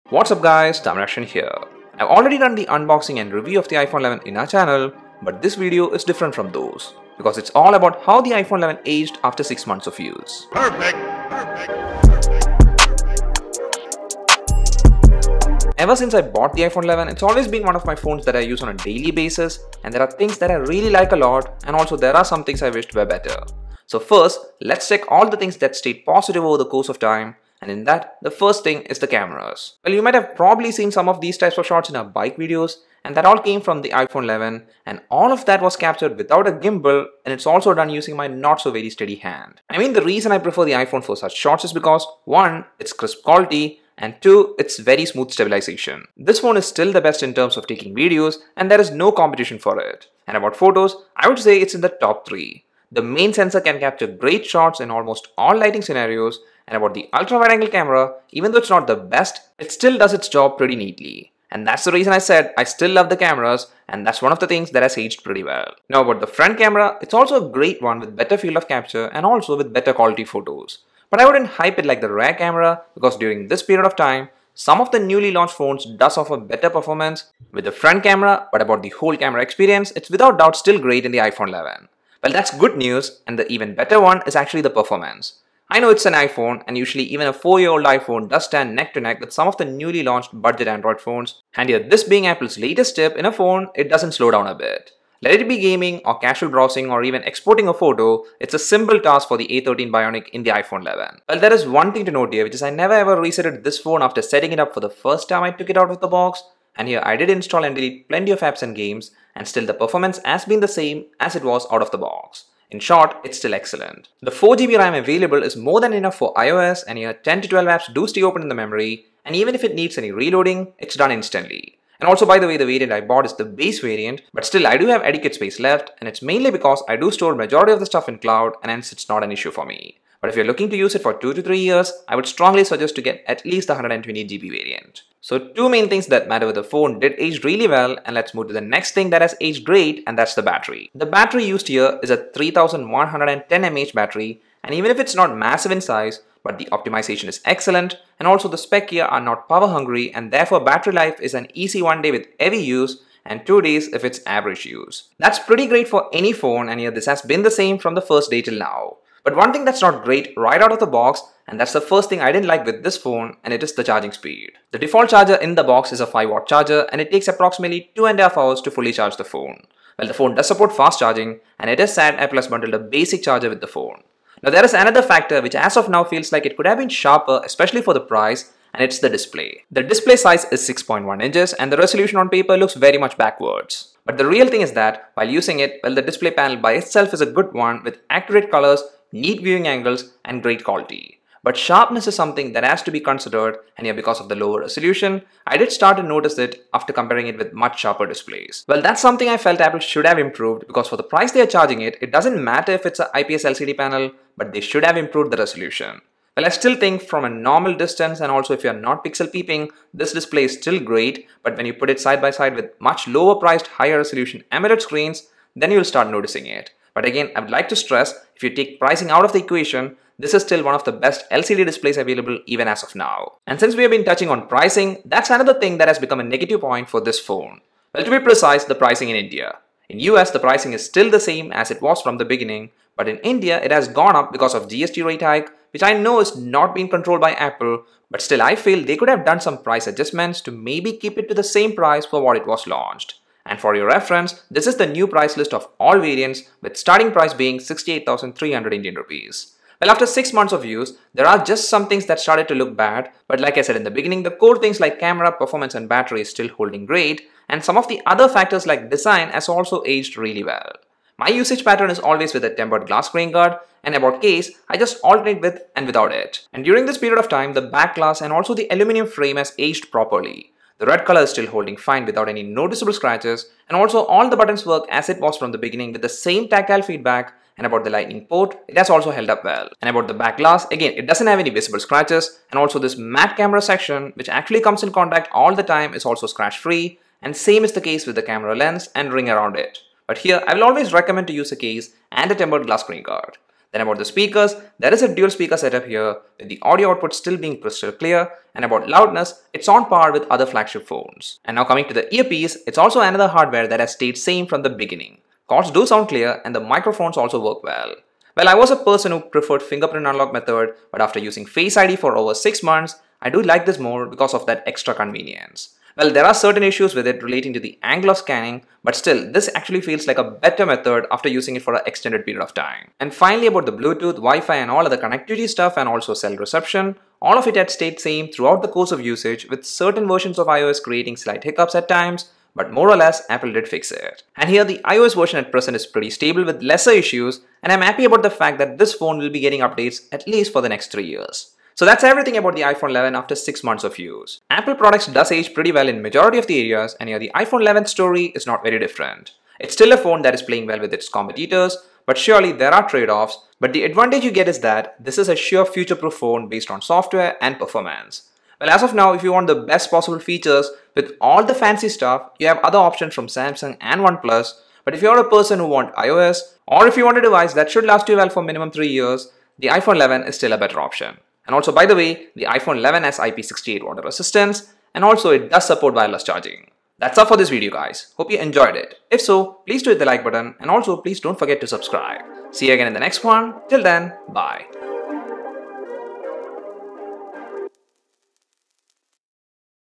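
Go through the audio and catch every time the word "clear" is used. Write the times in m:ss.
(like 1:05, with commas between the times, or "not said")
4:57, 5:06.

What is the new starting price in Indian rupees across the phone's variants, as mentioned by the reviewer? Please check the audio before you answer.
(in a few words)
68,300 rupees.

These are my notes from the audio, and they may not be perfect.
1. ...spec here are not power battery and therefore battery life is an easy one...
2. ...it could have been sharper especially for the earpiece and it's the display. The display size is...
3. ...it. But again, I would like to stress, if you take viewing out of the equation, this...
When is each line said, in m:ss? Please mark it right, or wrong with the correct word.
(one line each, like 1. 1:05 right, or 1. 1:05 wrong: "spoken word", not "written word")
1. 2:28 wrong: "hungry", not "battery"
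2. 2:56 wrong: "price", not "earpiece"
3. 3:36 wrong: "pricing", not "viewing".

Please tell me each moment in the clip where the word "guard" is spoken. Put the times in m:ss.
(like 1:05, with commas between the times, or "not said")
4:23, 4:53.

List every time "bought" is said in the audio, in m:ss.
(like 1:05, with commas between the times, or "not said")
0:16, 2:03.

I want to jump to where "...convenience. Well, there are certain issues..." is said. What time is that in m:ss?
5:14.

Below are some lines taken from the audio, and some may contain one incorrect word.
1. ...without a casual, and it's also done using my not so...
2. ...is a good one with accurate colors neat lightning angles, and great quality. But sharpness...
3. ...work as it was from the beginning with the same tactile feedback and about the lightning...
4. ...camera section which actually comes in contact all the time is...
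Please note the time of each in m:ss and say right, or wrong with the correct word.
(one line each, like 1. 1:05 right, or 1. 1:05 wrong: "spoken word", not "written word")
1. 0:36 wrong: "gimbal", not "casual"
2. 3:07 wrong: "viewing", not "lightning"
3. 4:34 right
4. 4:43 right.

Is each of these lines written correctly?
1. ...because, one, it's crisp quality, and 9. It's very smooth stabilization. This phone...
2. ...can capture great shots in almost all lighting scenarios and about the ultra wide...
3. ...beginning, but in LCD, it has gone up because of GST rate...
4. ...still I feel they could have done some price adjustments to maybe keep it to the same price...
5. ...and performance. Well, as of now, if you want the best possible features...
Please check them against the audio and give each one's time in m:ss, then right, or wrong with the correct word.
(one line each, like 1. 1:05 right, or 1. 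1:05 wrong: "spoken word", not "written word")
1. 0:41 wrong: "2", not "9"
2. 0:53 right
3. 3:52 wrong: "India", not "LCD"
4. 3:58 right
5. 5:57 right.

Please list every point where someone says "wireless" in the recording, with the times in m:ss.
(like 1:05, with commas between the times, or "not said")
6:15.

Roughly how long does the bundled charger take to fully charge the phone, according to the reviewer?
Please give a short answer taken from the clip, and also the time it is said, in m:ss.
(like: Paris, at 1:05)
2.5 hours, at 2:47.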